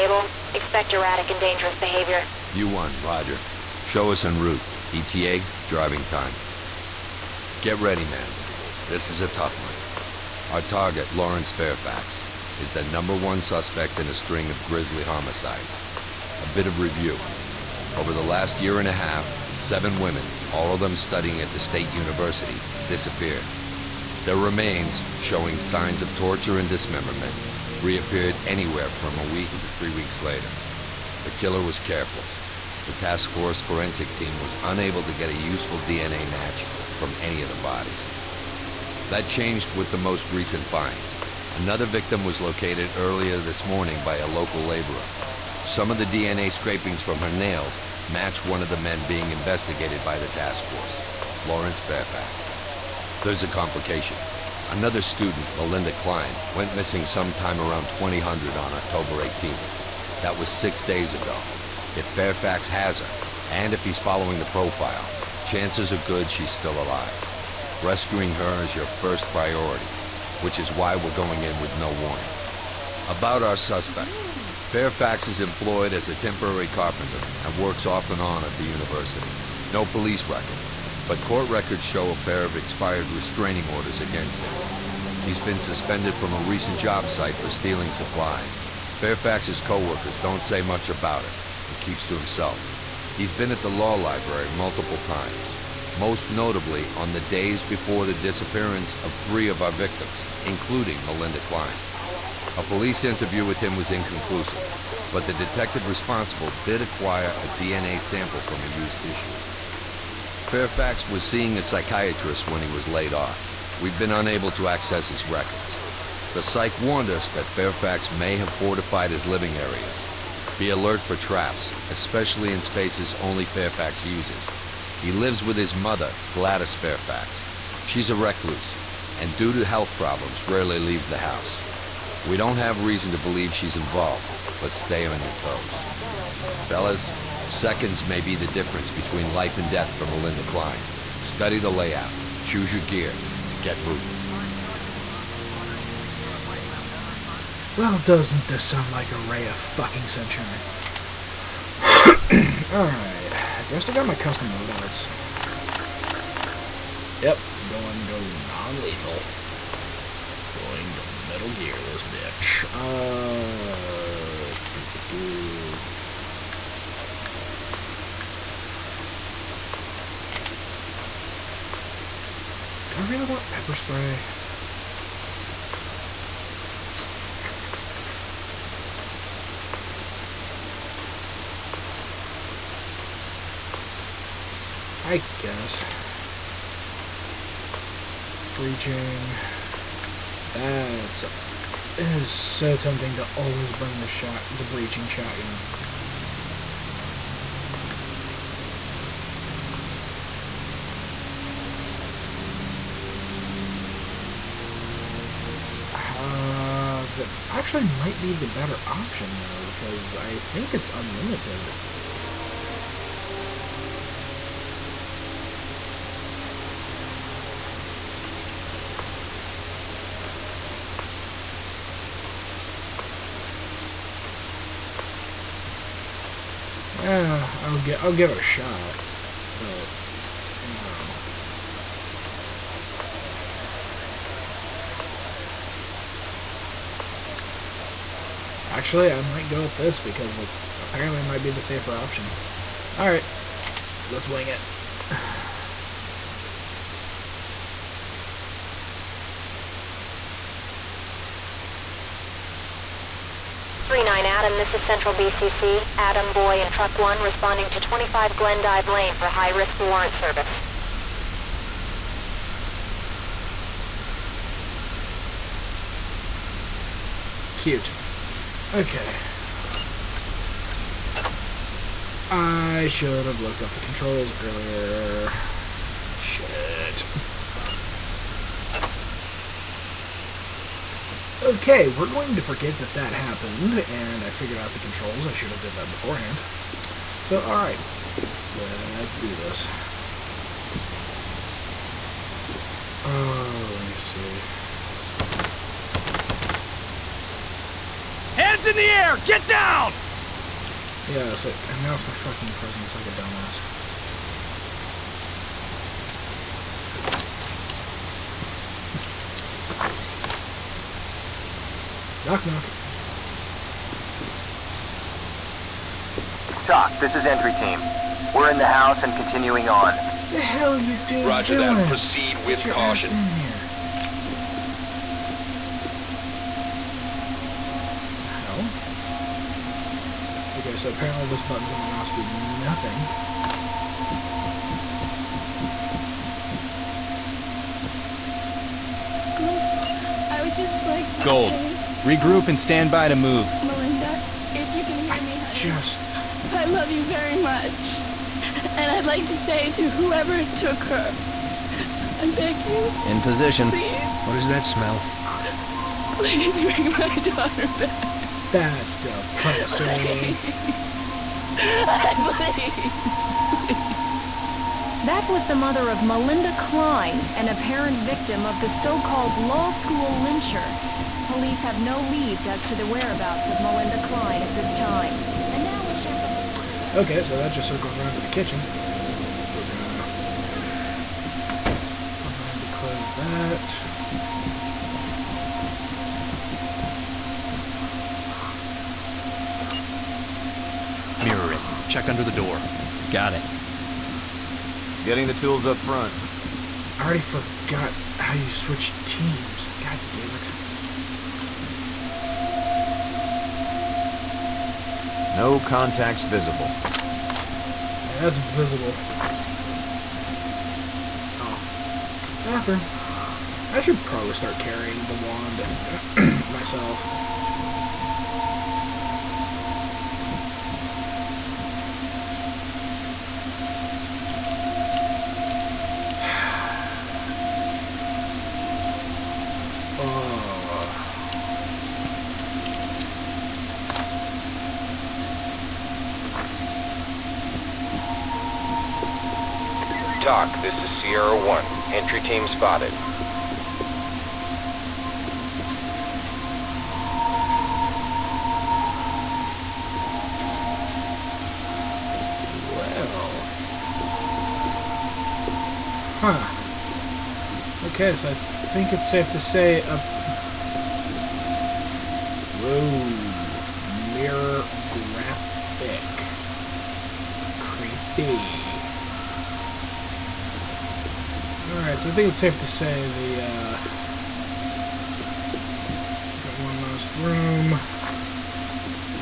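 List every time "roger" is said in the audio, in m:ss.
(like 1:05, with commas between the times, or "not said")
0:03, 5:21.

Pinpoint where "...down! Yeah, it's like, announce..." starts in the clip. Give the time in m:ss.
4:59.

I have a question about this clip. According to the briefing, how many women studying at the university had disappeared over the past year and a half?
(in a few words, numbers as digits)
7.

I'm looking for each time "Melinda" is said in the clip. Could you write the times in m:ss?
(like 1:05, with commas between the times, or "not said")
0:55, 1:41, 2:20, 5:43, 6:06, 6:13.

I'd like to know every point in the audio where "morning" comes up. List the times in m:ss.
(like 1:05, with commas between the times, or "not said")
0:43.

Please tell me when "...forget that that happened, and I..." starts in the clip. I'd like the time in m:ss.
4:42.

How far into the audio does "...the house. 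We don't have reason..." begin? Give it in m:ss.
2:11.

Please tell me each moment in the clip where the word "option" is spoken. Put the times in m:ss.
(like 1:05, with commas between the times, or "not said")
3:28, 4:01.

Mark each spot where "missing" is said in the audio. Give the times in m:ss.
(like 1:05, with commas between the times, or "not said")
0:56.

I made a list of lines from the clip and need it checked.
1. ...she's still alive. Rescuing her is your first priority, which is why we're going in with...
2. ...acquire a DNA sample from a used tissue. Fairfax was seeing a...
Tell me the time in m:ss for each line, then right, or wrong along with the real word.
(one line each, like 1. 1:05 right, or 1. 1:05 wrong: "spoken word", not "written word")
1. 1:06 right
2. 1:46 right.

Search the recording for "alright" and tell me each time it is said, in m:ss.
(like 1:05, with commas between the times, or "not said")
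2:32, 4:47.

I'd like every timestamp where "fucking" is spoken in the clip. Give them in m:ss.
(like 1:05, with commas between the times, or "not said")
2:29, 5:02.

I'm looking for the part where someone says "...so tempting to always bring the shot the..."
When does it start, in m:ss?
3:12.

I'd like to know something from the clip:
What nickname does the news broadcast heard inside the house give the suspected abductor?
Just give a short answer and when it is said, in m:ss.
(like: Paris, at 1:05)
Law school lyncher, at 6:09.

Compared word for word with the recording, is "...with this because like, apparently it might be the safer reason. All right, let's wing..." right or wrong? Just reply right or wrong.
wrong.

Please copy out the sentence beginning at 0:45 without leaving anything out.
Some of the DNA scrapings from her nails match one of the men being investigated by the task force, Lawrence Fairfax.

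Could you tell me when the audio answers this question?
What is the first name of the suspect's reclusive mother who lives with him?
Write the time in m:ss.
2:06.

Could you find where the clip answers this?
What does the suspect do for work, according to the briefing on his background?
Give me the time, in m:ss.
1:16.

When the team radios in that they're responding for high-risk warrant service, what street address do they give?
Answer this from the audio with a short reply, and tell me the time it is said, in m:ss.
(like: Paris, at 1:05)
25 Glendive Lane, at 4:17.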